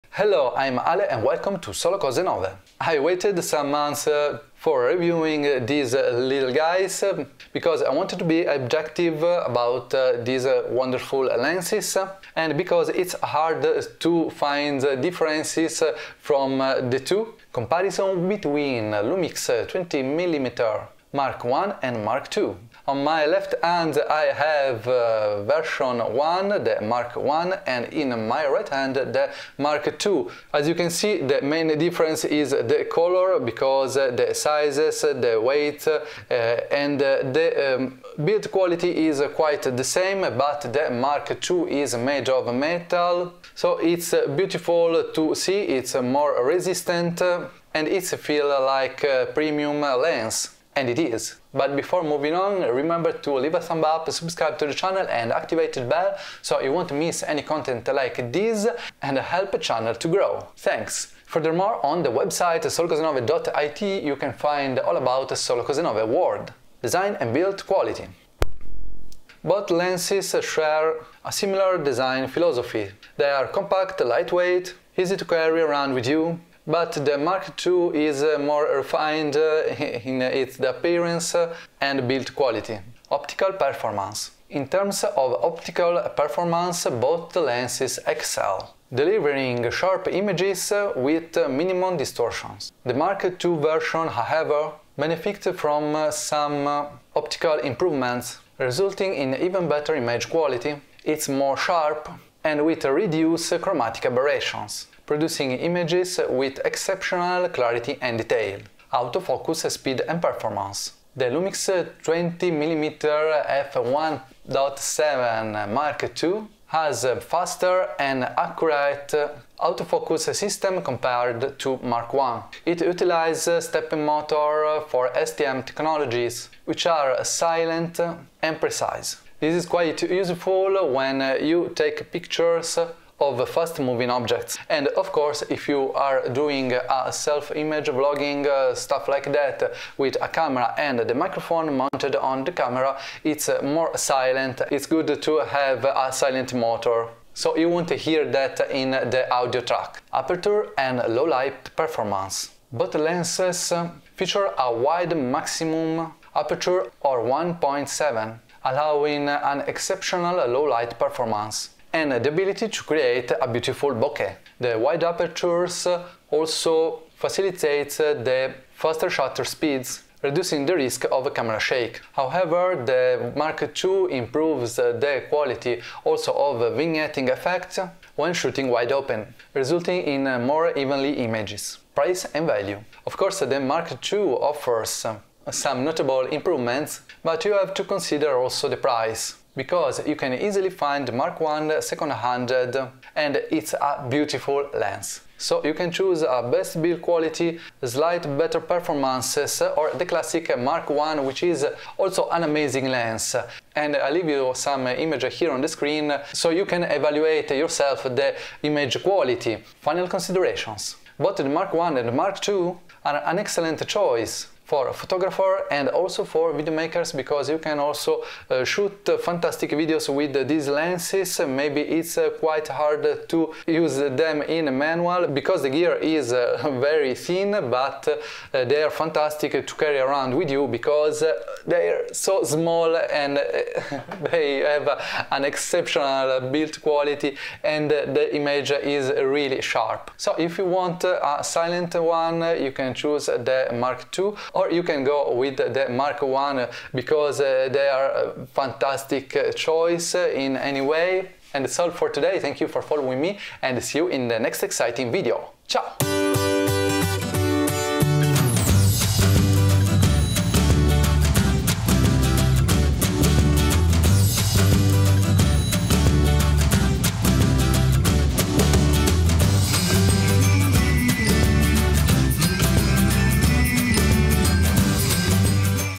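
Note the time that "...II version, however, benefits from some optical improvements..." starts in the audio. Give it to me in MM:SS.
01:33.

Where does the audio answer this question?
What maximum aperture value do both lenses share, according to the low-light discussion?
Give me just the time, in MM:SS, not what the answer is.
02:37.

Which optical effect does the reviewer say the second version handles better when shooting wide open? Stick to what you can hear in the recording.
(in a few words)
Vignetting.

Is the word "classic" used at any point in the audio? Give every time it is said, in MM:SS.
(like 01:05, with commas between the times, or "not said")
03:20.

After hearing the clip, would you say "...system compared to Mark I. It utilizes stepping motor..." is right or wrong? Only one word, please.
right.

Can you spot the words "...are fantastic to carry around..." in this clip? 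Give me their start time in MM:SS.
03:48.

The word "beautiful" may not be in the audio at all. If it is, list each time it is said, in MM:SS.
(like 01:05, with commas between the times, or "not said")
00:44, 02:43, 03:14.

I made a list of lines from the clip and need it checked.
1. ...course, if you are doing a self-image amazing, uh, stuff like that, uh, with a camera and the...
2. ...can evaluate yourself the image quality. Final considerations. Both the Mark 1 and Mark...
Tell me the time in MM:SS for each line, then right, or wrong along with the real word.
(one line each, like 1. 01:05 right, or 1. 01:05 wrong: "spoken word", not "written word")
1. 02:15 wrong: "vlogging", not "amazing"
2. 03:26 right.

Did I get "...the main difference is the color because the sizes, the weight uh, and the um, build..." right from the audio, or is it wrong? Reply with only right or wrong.
right.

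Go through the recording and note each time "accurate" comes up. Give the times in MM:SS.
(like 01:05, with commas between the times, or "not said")
01:58.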